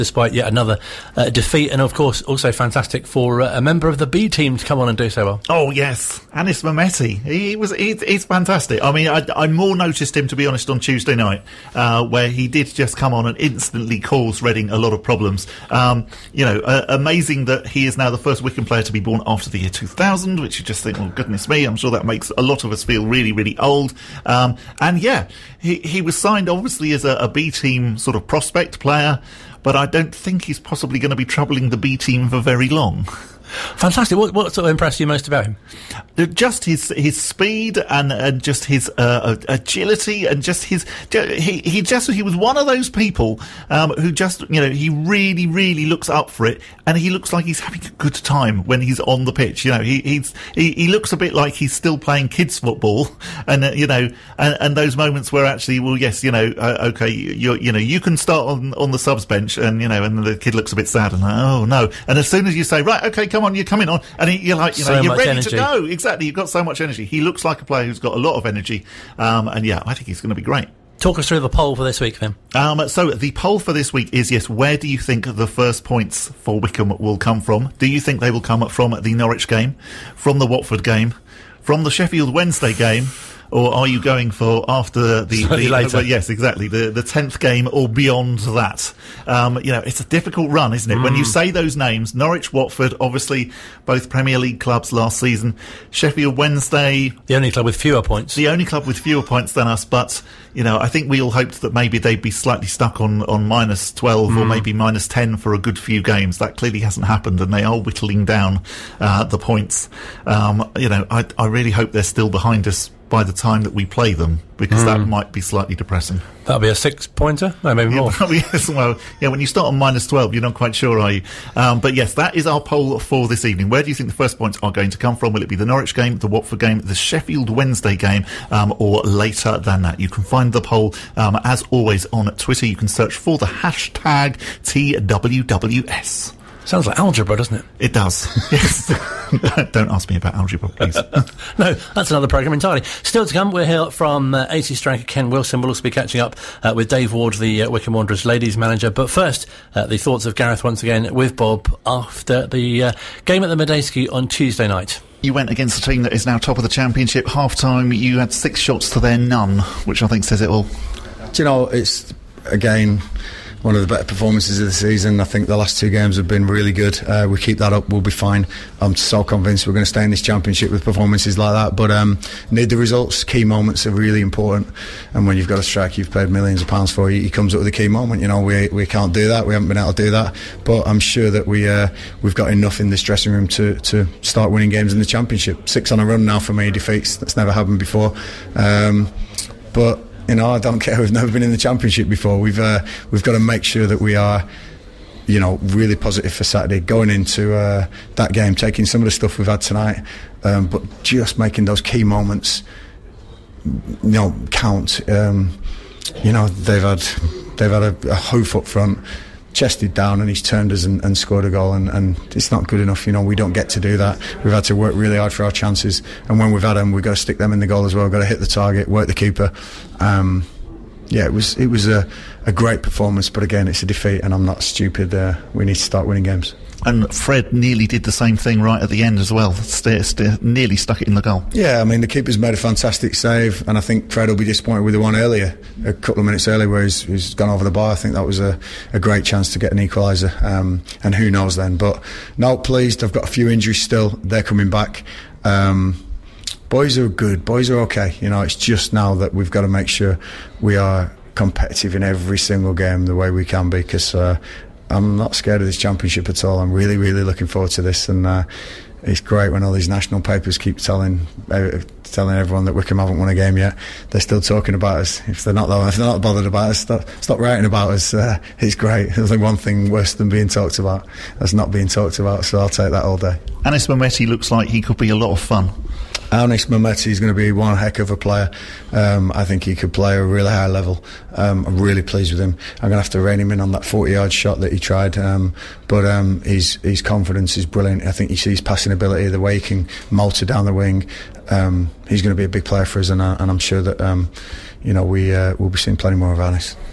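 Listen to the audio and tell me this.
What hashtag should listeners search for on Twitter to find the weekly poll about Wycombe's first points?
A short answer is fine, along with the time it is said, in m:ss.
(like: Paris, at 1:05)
TWWS, at 2:14.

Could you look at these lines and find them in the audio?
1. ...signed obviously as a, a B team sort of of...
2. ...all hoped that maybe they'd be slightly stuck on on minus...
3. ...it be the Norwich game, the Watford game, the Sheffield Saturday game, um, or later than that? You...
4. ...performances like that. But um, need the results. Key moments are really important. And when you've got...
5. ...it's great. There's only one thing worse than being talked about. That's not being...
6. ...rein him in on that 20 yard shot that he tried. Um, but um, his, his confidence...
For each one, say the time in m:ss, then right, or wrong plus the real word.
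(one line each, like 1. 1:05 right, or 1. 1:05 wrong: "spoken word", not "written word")
1. 0:26 right
2. 1:41 right
3. 2:05 wrong: "Wednesday", not "Saturday"
4. 2:50 right
5. 4:28 right
6. 4:43 wrong: "40", not "20".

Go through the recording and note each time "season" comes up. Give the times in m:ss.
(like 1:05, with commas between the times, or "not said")
1:35, 2:44.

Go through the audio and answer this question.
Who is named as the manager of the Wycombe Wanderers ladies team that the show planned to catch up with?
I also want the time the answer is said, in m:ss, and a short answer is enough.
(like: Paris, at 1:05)
Dave Ward, at 2:26.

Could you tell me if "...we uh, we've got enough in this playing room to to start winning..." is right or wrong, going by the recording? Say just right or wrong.
wrong.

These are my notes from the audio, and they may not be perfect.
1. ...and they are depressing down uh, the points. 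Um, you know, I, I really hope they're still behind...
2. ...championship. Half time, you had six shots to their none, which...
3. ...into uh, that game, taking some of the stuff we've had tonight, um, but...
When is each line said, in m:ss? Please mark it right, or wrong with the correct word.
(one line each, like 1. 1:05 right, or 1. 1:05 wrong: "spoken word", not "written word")
1. 1:47 wrong: "whittling", not "depressing"
2. 2:36 right
3. 3:17 right.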